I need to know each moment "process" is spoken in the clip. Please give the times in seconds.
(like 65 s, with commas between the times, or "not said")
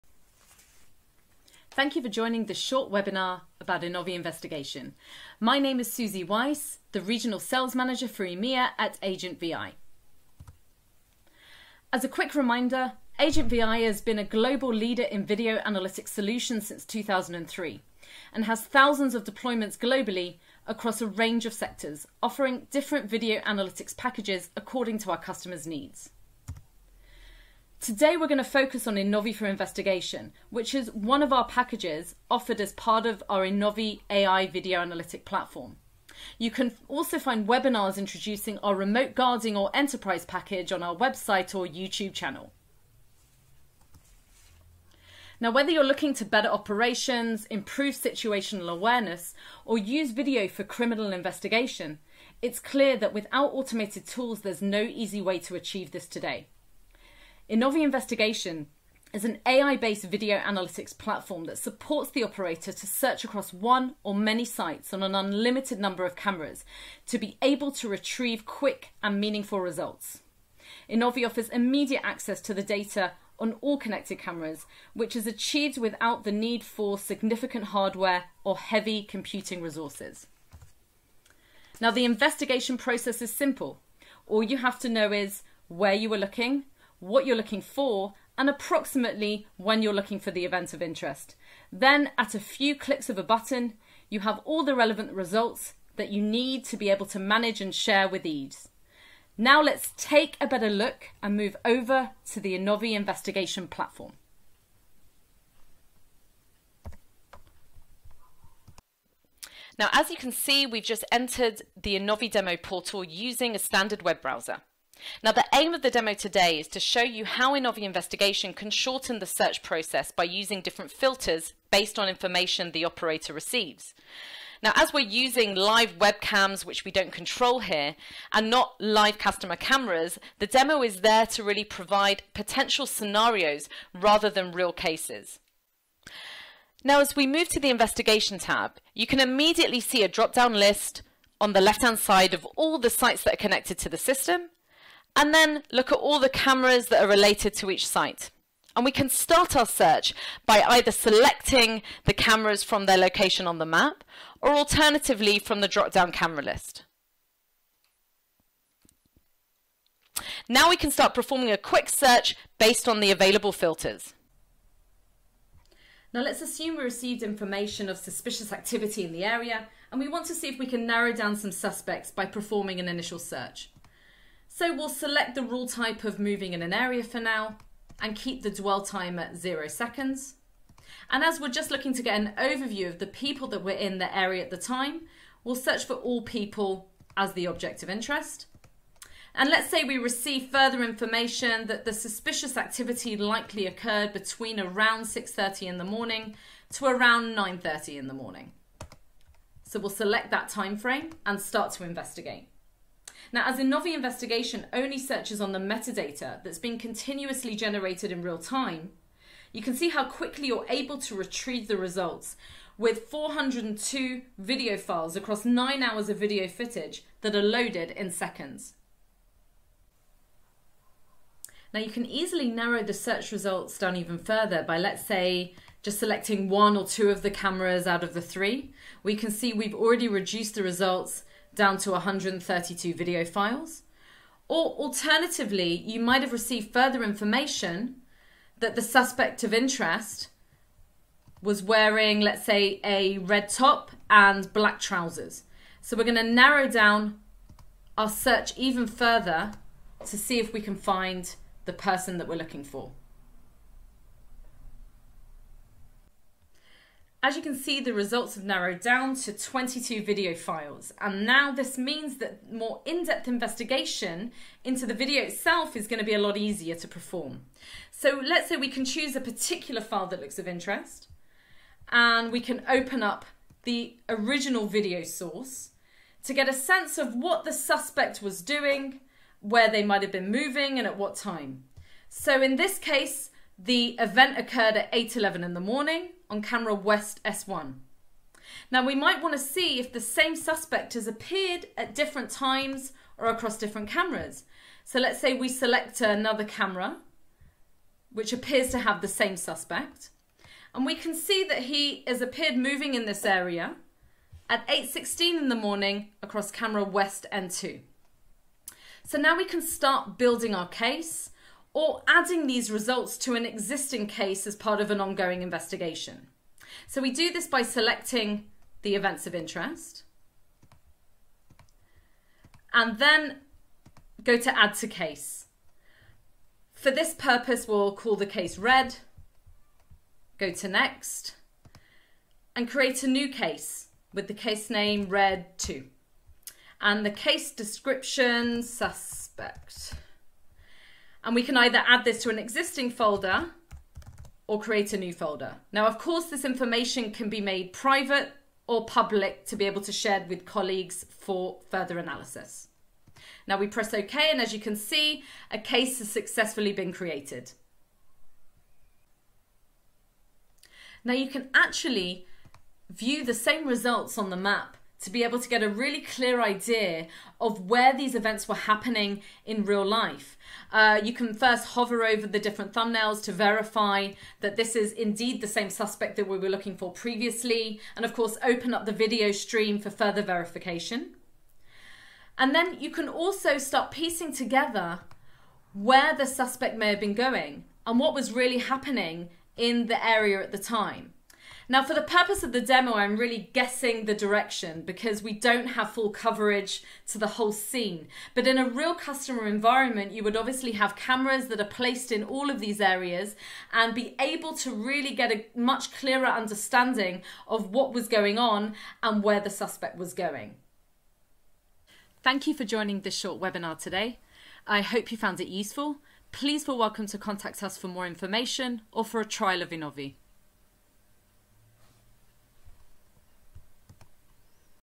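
82 s, 119 s.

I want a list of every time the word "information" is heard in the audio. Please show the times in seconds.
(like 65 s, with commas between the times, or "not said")
122 s, 167 s, 190 s, 237 s, 346 s, 418 s.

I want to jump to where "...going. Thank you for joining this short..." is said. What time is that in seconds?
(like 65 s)
410 s.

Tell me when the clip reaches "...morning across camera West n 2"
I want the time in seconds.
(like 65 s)
305 s.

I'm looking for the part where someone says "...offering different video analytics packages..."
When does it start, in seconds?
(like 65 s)
22 s.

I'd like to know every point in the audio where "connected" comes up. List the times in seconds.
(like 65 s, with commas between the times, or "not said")
73 s, 143 s.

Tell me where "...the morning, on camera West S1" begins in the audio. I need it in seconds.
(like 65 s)
285 s.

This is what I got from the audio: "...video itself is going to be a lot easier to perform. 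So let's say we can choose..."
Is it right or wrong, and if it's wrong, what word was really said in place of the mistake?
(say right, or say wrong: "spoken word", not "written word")
right.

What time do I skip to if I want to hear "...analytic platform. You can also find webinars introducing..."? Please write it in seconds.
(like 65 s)
34 s.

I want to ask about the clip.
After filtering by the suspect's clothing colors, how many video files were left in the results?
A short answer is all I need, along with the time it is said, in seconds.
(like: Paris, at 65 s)
22, at 259 s.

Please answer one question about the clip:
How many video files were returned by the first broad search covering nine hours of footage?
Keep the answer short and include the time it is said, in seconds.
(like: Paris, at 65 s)
402, at 213 s.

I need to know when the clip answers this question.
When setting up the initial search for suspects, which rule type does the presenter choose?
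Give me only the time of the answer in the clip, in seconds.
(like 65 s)
176 s.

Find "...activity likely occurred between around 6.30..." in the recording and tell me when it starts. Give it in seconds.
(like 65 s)
192 s.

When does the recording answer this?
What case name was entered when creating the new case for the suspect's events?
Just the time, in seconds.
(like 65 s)
335 s.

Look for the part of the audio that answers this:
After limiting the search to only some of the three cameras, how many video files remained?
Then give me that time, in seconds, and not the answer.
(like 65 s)
231 s.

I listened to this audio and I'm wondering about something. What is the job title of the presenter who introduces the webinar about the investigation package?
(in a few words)
Regional Sales Manager.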